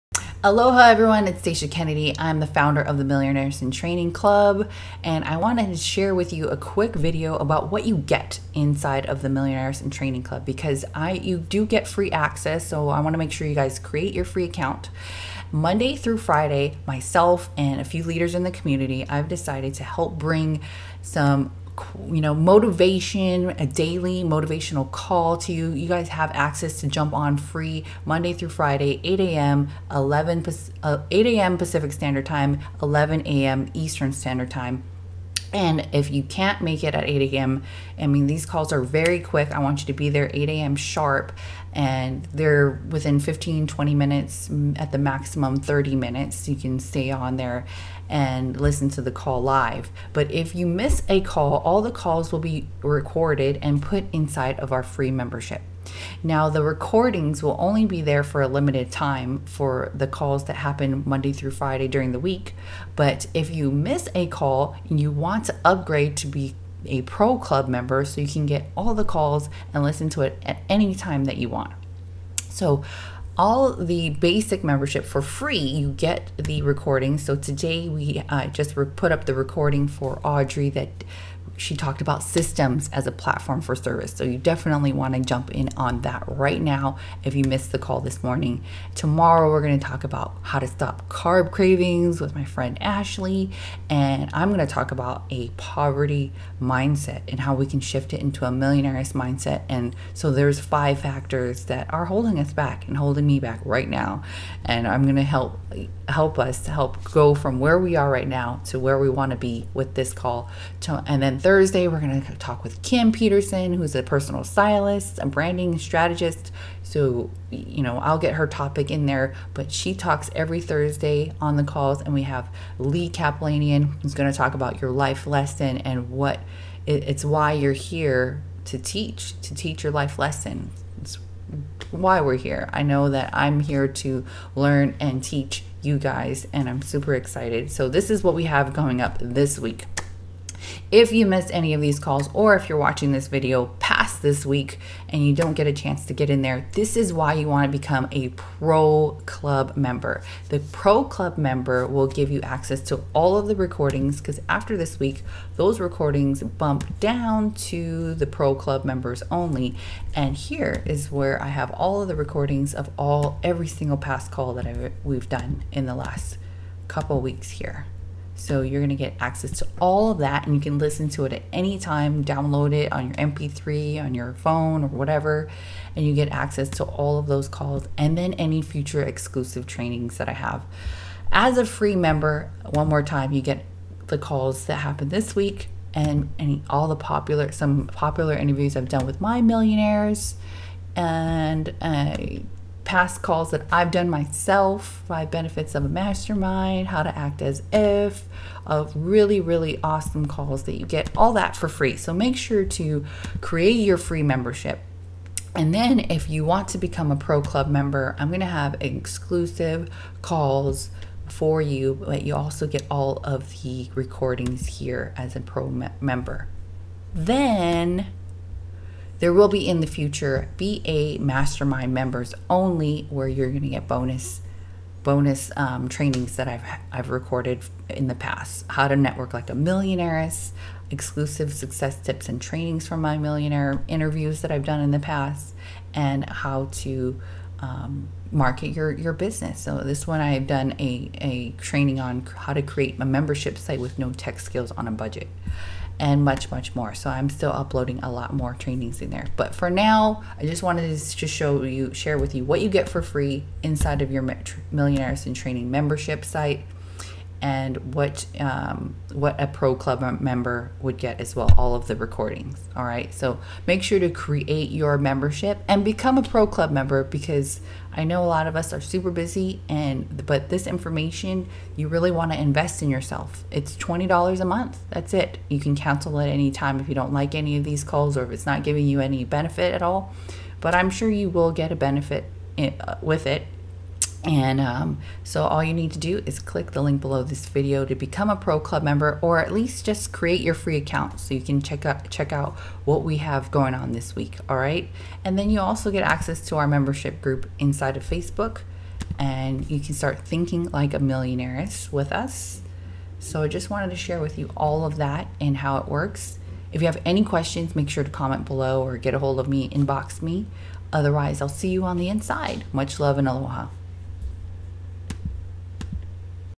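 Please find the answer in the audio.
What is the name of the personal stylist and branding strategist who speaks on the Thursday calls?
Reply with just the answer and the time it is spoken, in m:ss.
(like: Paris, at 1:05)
Kim Peterson, at 1:52.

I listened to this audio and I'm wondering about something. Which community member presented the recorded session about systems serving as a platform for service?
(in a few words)
Audrey.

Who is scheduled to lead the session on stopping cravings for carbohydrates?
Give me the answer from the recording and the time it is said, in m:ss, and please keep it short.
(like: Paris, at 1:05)
Ashley, at 1:32.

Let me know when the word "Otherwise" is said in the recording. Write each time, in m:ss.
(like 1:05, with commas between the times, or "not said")
5:10.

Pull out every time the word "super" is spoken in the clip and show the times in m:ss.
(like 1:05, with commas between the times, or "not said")
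2:16, 4:28.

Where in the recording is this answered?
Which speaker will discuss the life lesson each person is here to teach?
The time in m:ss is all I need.
2:02.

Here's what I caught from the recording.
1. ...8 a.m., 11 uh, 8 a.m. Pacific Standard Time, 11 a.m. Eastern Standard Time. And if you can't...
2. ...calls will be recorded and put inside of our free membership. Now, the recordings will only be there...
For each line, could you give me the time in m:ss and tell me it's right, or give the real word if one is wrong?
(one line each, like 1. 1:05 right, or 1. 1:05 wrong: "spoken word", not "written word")
1. 0:29 right
2. 0:51 right.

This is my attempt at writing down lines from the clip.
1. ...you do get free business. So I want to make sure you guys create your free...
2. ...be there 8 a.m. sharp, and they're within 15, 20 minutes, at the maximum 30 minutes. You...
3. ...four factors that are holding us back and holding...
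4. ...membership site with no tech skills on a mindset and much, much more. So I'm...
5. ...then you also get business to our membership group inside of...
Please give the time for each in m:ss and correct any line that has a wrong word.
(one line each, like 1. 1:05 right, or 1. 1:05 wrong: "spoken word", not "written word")
1. 0:11 wrong: "access", not "business"
2. 0:39 right
3. 1:40 wrong: "five", not "four"
4. 4:03 wrong: "budget", not "mindset"
5. 4:55 wrong: "access", not "business".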